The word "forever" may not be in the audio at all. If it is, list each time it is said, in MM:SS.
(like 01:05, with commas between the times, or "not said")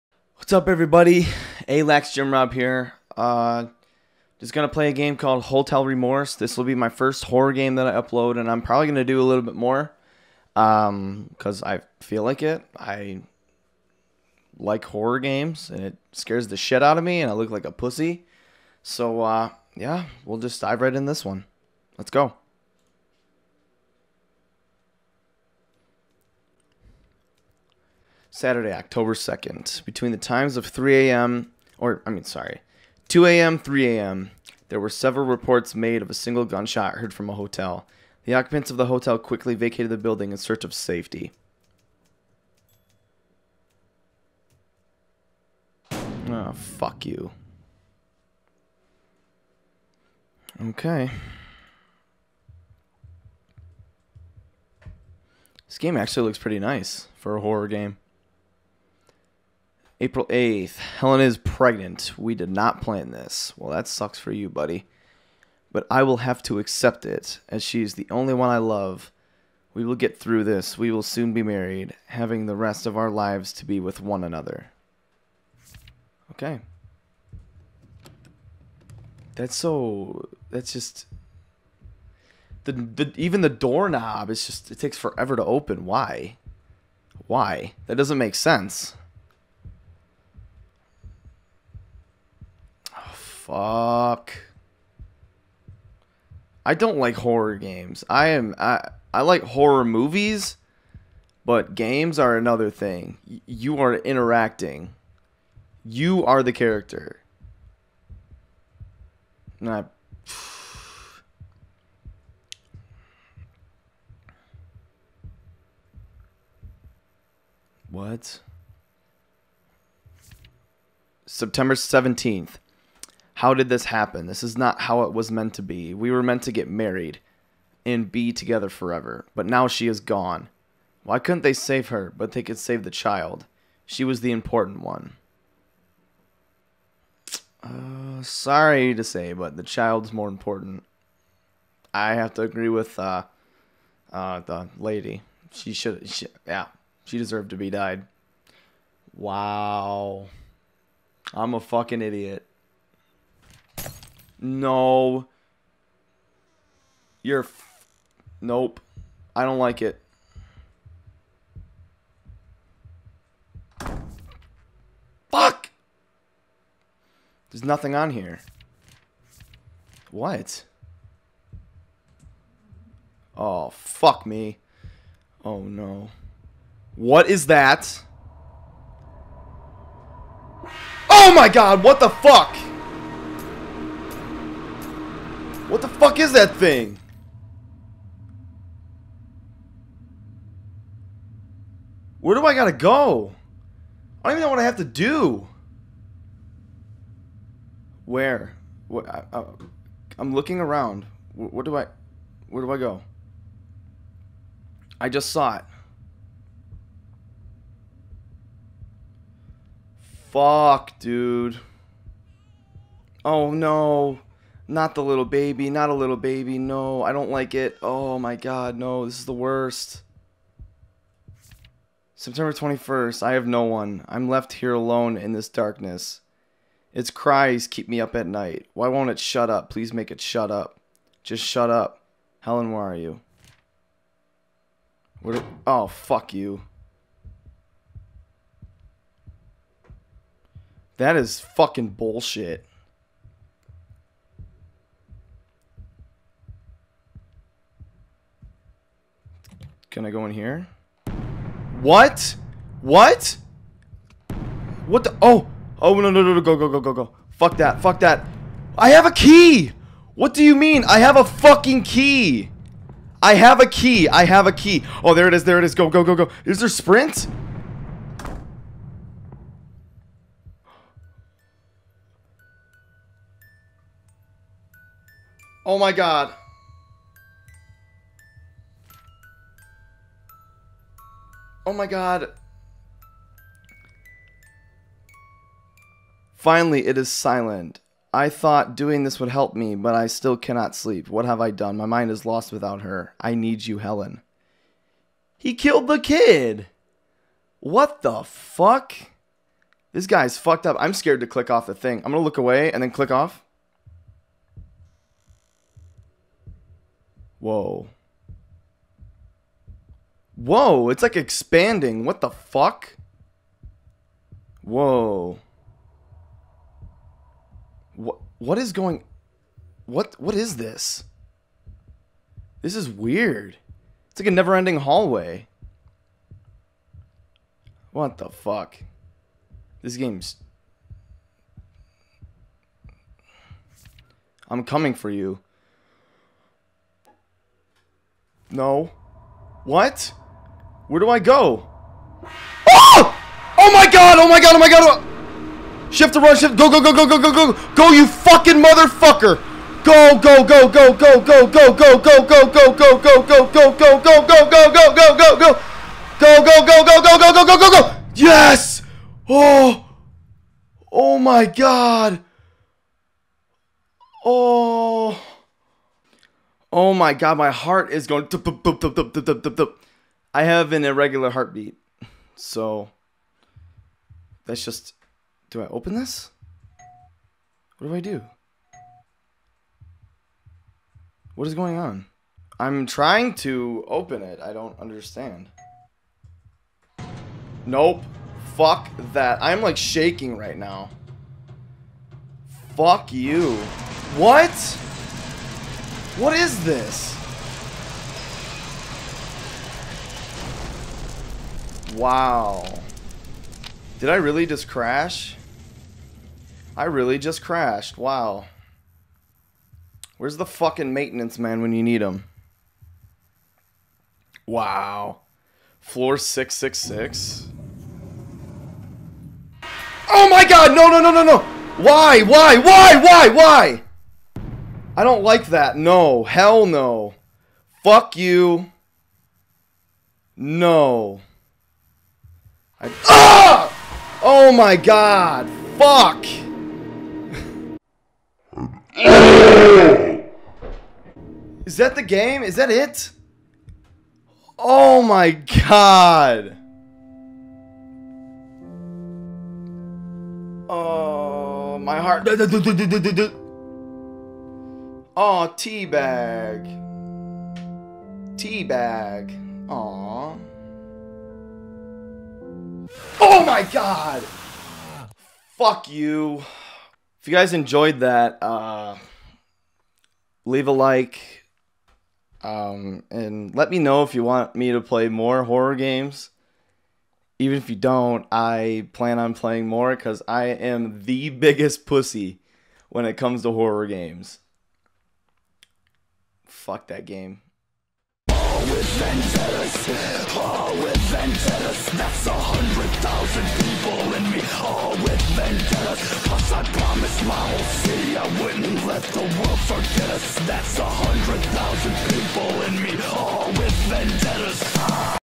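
01:24, 02:08.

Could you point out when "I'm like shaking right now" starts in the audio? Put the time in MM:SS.
06:29.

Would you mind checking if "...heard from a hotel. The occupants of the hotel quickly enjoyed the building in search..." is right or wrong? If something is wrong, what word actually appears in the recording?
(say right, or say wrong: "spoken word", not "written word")
wrong: "vacated", not "enjoyed".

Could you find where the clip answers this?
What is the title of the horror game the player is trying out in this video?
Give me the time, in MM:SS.
00:05.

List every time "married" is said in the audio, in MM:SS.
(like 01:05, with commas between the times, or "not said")
01:11, 02:06.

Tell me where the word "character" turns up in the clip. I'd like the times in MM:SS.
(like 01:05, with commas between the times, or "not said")
01:46.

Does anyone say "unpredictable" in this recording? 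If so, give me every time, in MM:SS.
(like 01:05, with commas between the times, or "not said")
not said.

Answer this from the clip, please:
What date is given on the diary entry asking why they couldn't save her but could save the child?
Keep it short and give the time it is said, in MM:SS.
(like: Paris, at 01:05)
September 17th, at 02:01.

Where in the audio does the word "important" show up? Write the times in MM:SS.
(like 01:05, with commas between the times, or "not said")
02:14, 02:20.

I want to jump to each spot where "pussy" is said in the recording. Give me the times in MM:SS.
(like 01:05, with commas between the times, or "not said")
00:17, 08:01.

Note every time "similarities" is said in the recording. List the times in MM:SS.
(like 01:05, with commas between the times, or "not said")
not said.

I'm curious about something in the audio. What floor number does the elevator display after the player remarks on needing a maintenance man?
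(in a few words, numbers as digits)
666.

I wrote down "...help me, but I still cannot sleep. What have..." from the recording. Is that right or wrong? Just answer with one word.
right.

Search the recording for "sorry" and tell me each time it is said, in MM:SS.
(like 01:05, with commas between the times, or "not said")
00:32, 02:18.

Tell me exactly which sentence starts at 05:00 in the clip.
I'm scared to click off the thing.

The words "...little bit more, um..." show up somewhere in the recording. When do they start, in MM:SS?
00:09.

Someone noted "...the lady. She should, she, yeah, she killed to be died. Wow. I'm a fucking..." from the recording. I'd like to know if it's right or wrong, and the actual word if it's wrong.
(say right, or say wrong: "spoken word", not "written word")
wrong: "deserved", not "killed".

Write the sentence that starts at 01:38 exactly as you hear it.
I am I I like horror movies, but games are another thing.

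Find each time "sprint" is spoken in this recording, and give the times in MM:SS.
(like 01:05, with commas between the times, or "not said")
04:26.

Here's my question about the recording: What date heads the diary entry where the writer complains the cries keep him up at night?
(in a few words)
September 21st.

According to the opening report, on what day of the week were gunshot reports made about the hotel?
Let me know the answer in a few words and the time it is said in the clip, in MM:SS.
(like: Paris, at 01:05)
Saturday, at 00:28.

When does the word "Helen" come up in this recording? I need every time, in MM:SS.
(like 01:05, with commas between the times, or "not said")
01:00, 03:52, 04:53.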